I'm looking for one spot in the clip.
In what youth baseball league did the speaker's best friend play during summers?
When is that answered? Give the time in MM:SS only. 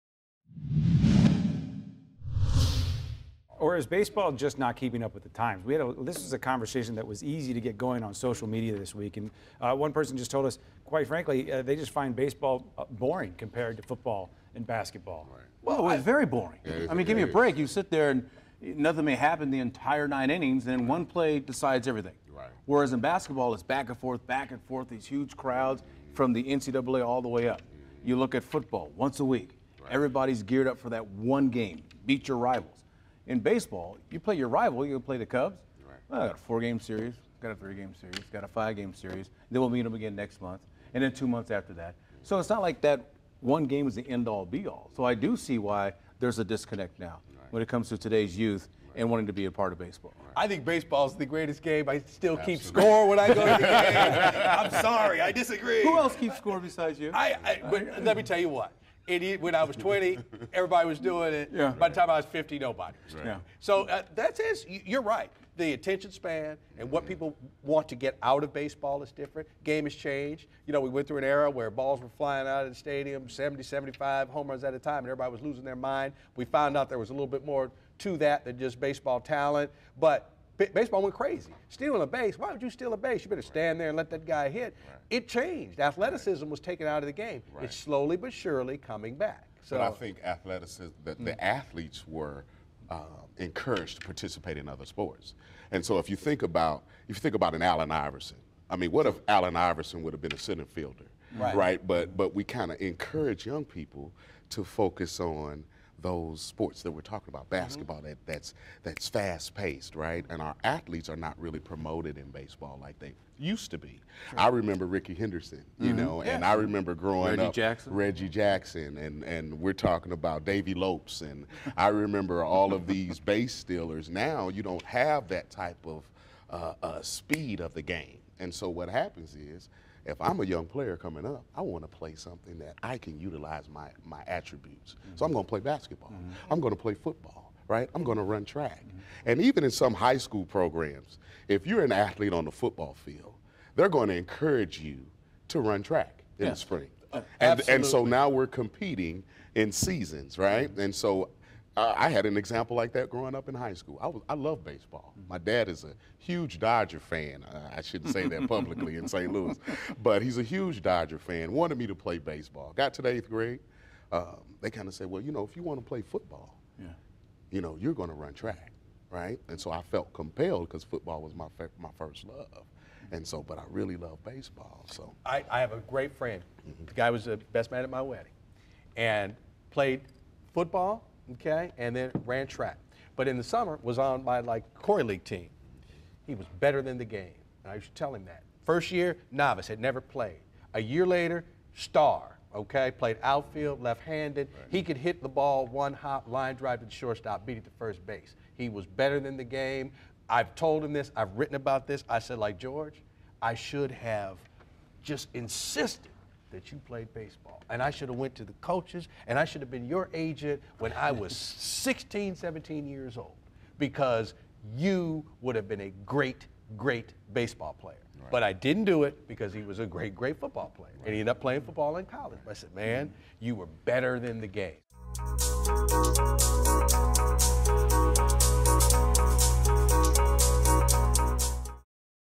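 03:04.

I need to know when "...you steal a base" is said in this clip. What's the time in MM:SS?
01:22.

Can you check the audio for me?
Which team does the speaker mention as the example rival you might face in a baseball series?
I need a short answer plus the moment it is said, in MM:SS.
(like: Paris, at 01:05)
Cubs, at 00:35.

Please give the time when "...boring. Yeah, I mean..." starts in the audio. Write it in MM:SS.
00:16.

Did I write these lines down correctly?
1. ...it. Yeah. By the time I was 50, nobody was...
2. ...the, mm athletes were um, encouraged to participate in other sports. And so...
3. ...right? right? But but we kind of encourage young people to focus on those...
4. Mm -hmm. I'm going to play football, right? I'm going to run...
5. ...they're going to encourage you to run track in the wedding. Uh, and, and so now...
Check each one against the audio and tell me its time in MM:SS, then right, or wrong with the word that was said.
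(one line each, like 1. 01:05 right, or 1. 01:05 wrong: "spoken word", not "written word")
1. 01:01 right
2. 01:31 right
3. 01:41 right
4. 02:16 right
5. 02:23 wrong: "spring", not "wedding".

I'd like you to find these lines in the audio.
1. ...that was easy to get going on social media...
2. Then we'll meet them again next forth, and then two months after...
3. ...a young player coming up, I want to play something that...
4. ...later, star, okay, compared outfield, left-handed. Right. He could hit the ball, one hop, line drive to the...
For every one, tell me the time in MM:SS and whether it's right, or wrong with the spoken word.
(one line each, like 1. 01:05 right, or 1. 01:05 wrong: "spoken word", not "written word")
1. 00:06 right
2. 00:39 wrong: "month", not "forth"
3. 02:10 right
4. 03:11 wrong: "played", not "compared".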